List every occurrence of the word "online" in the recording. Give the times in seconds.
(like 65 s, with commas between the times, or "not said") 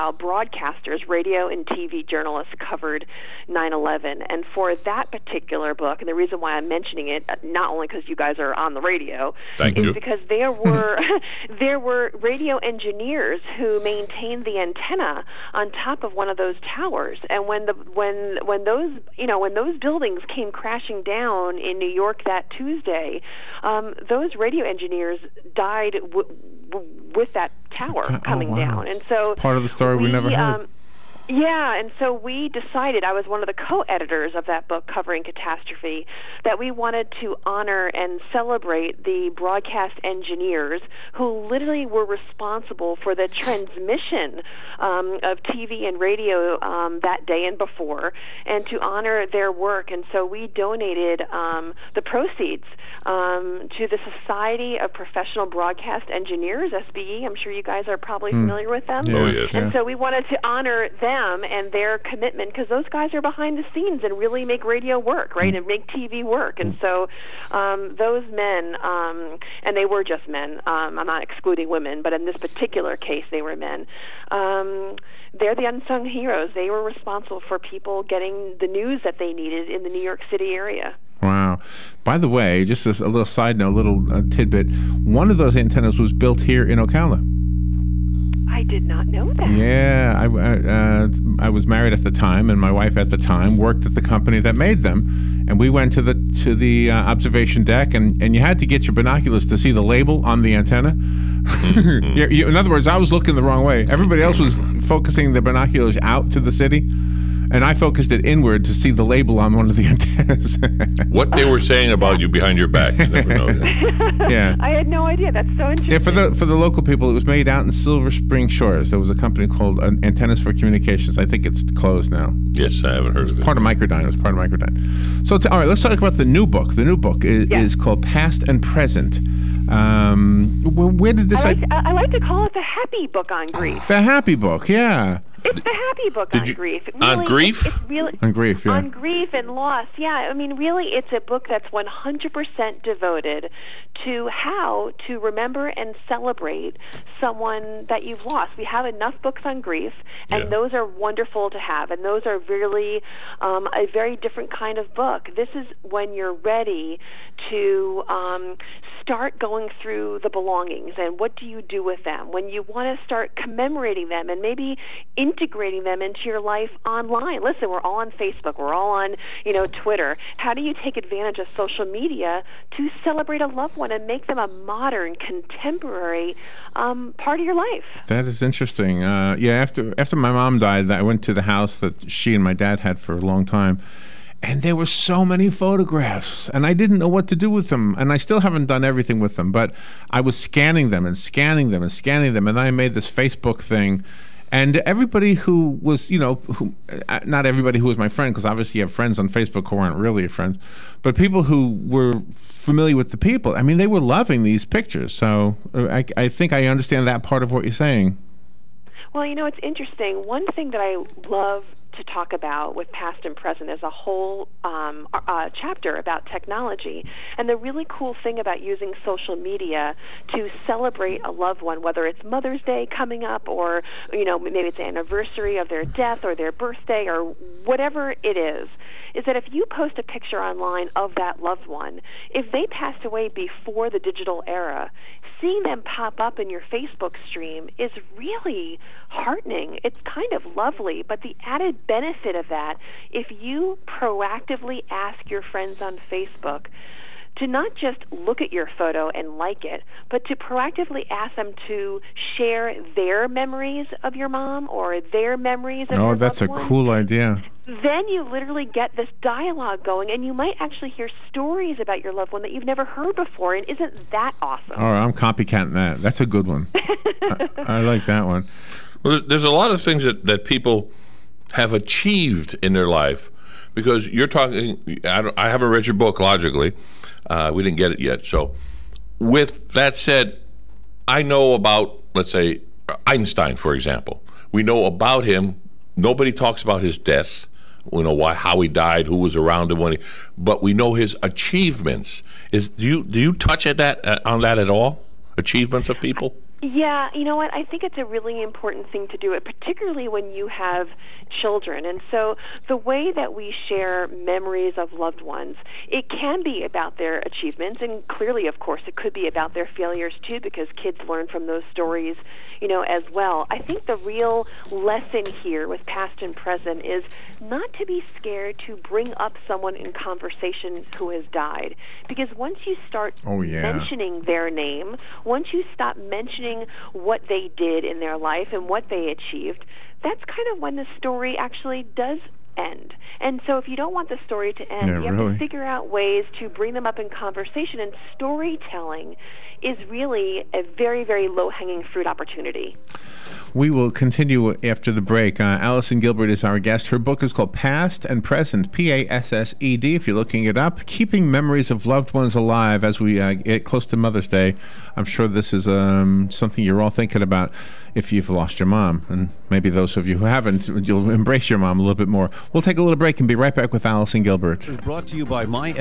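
166 s, 230 s.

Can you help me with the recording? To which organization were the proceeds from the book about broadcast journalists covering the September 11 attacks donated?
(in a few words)
Society of Professional Broadcast Engineers.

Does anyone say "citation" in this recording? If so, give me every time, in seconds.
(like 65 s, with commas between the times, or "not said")
not said.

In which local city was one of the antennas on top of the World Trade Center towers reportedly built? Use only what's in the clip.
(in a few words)
Ocala.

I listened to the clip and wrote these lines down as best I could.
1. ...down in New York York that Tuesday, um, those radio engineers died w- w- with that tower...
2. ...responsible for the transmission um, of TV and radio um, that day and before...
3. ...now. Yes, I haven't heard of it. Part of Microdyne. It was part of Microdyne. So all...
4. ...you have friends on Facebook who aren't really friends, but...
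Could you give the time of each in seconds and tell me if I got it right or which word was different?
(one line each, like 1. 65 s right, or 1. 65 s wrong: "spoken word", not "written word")
1. 21 s right
2. 42 s right
3. 122 s right
4. 198 s right.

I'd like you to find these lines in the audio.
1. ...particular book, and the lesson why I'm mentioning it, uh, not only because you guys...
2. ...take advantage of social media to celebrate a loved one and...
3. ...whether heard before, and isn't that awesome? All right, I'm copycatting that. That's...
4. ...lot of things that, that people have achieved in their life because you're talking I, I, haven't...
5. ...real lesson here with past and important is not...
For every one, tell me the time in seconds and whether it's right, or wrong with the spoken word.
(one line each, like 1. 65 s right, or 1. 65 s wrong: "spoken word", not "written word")
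1. 5 s wrong: "reason", not "lesson"
2. 170 s right
3. 262 s wrong: "never", not "whether"
4. 269 s right
5. 313 s wrong: "present", not "important".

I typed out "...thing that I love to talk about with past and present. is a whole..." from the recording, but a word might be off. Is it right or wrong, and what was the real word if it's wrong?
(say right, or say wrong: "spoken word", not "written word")
right.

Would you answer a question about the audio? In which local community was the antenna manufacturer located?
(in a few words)
Silver Spring Shores.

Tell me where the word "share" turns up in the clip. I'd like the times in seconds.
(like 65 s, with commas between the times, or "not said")
252 s, 303 s.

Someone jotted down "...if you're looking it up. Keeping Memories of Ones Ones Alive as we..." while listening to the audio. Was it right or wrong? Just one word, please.
wrong.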